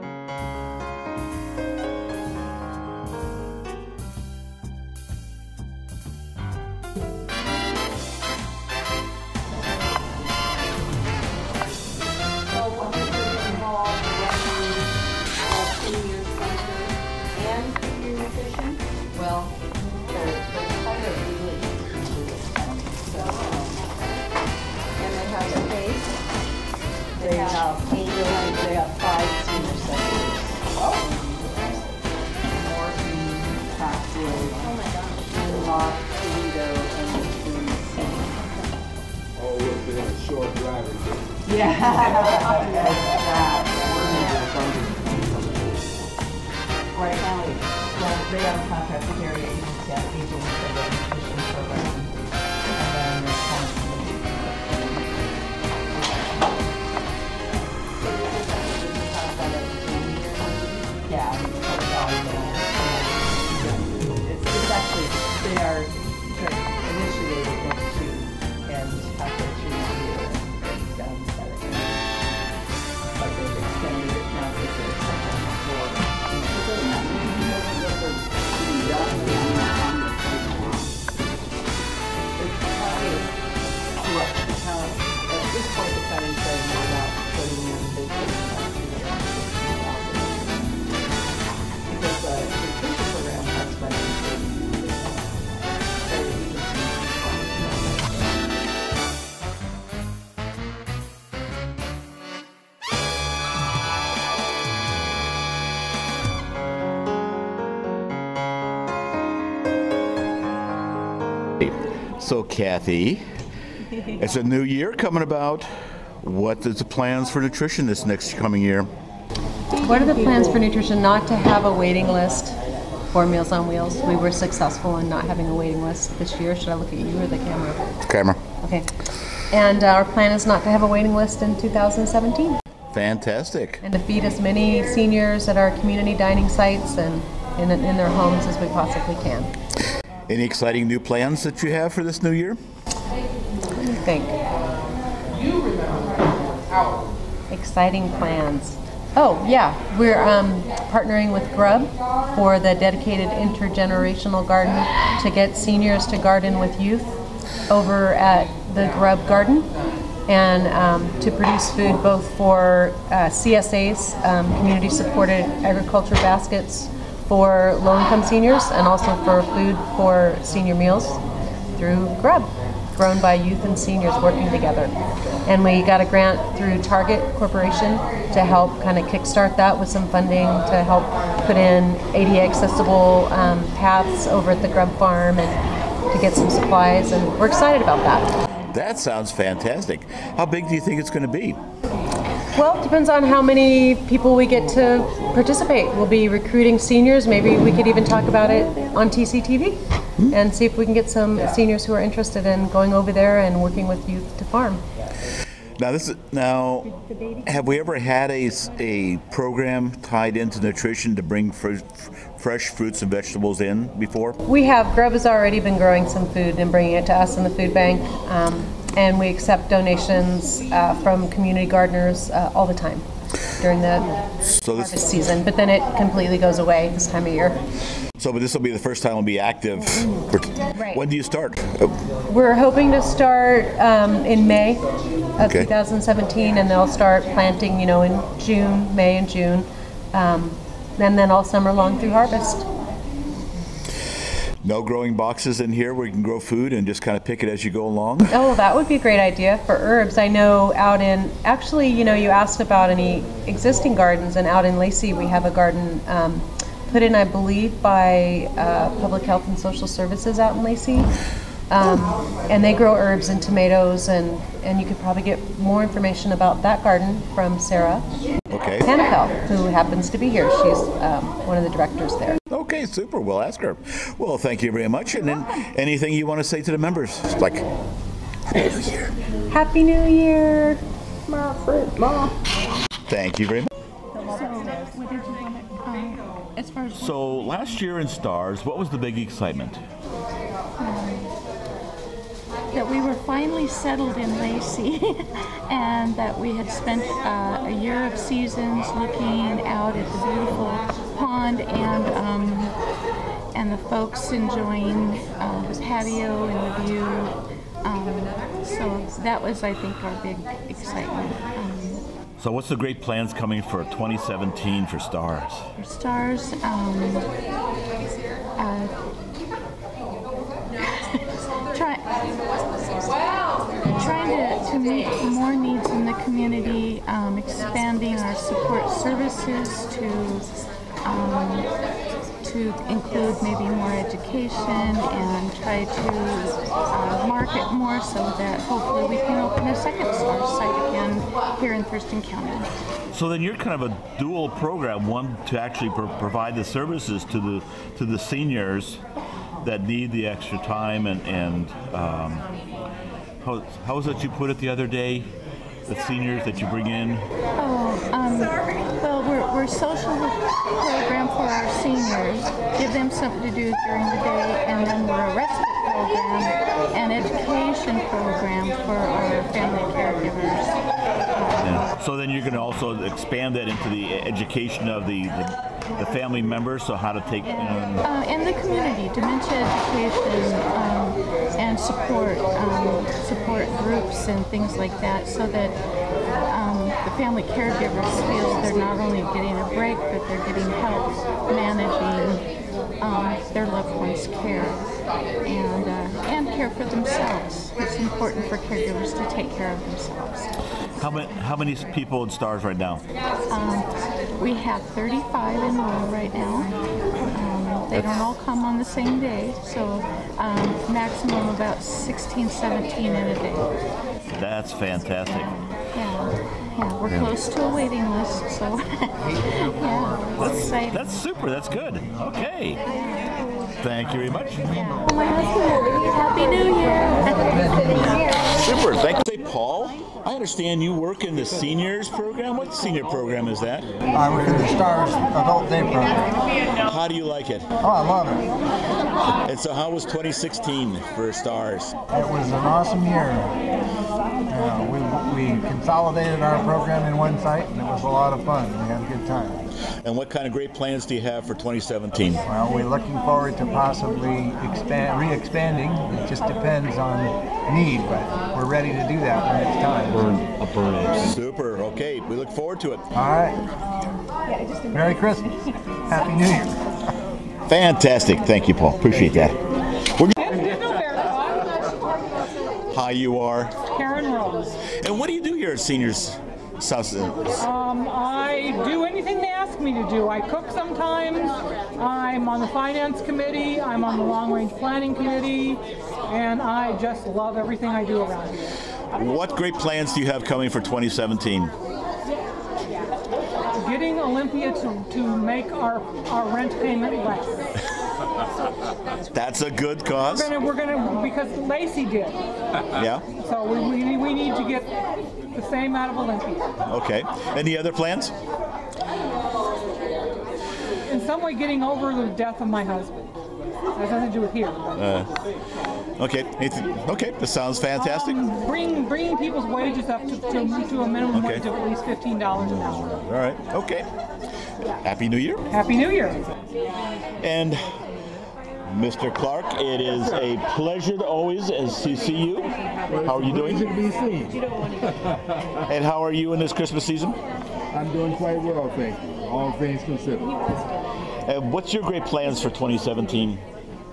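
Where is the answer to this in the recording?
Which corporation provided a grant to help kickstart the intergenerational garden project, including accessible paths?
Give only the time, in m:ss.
2:56.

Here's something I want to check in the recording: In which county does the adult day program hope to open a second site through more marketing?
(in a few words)
Thurston County.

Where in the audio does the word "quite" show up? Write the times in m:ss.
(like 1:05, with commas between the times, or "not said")
8:58.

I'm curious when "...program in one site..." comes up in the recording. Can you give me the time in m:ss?
7:26.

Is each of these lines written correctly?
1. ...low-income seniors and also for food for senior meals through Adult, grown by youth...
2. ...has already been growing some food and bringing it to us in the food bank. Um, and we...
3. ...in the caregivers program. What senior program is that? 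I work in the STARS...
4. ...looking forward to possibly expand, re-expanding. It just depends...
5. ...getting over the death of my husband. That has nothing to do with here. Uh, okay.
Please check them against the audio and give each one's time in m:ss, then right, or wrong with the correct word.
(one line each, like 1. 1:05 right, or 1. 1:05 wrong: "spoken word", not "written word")
1. 2:47 wrong: "Grub", not "Adult"
2. 3:35 right
3. 7:11 wrong: "seniors", not "caregivers"
4. 7:32 right
5. 8:31 right.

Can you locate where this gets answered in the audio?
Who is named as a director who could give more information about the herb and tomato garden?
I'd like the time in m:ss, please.
4:27.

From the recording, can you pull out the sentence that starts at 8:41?
wage of at least fifteen dollars an hour.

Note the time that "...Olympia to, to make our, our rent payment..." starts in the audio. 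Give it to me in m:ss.
8:14.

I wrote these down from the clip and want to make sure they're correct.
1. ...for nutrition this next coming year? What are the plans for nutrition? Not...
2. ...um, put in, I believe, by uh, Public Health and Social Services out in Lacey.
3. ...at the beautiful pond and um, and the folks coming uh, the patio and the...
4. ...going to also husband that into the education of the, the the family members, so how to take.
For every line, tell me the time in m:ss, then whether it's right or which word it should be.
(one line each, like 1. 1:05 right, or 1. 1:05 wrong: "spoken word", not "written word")
1. 1:57 right
2. 4:16 right
3. 4:59 wrong: "enjoying", not "coming"
4. 6:12 wrong: "expand", not "husband".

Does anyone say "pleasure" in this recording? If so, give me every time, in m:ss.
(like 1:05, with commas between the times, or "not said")
8:50.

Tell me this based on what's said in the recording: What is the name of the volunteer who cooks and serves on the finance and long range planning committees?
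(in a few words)
Karen Rose.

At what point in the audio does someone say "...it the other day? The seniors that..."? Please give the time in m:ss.
5:54.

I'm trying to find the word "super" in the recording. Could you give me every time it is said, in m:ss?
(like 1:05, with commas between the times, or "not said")
4:32, 7:01, 7:08, 7:41.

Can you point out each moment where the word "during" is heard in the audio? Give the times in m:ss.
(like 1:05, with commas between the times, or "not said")
3:43, 6:03.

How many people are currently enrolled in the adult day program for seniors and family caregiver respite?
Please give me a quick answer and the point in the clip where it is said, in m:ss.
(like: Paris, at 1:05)
35, at 6:44.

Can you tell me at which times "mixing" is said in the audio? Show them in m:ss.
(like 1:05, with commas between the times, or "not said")
not said.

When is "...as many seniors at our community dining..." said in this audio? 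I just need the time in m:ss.
2:14.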